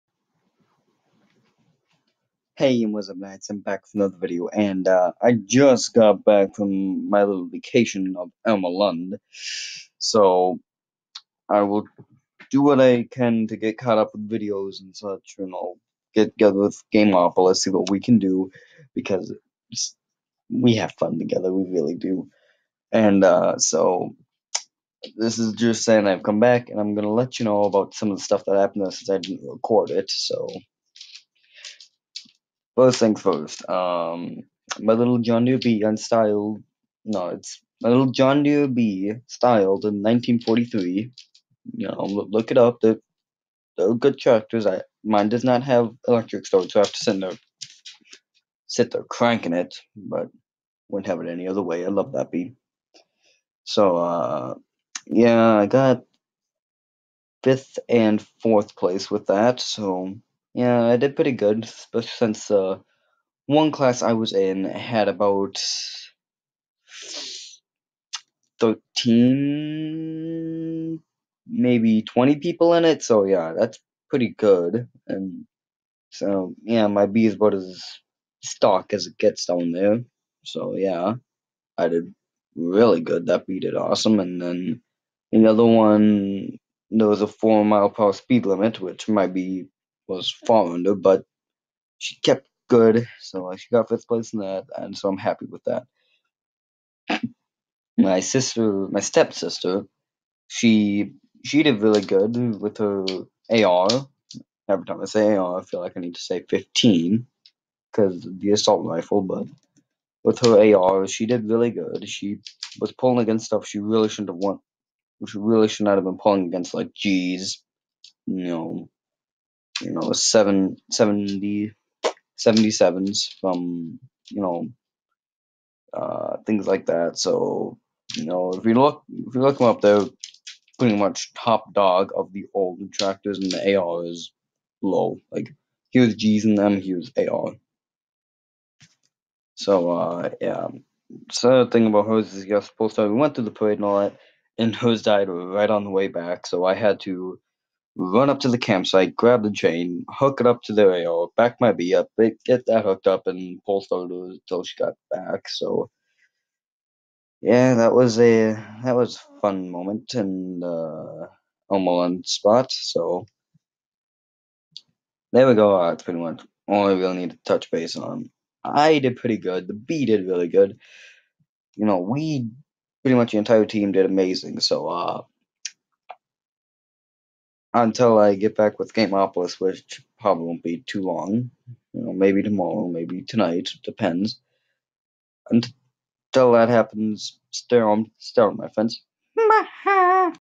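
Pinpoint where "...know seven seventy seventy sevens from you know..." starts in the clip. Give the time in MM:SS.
01:59.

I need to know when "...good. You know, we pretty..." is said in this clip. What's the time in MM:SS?
02:50.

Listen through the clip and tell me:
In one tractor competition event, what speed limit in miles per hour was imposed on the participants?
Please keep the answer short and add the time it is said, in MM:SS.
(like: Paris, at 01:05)
4, at 01:27.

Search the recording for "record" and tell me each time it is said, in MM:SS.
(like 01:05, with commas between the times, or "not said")
00:29.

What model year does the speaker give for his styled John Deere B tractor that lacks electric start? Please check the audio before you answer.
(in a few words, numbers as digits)
1943.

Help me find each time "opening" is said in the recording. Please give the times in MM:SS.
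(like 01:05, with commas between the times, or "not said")
not said.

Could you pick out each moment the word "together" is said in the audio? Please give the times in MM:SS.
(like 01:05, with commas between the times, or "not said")
00:16, 00:21.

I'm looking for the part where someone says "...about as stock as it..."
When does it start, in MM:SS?
01:17.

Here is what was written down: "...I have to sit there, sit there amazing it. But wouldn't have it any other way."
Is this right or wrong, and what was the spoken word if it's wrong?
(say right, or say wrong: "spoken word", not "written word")
wrong: "cranking", not "amazing".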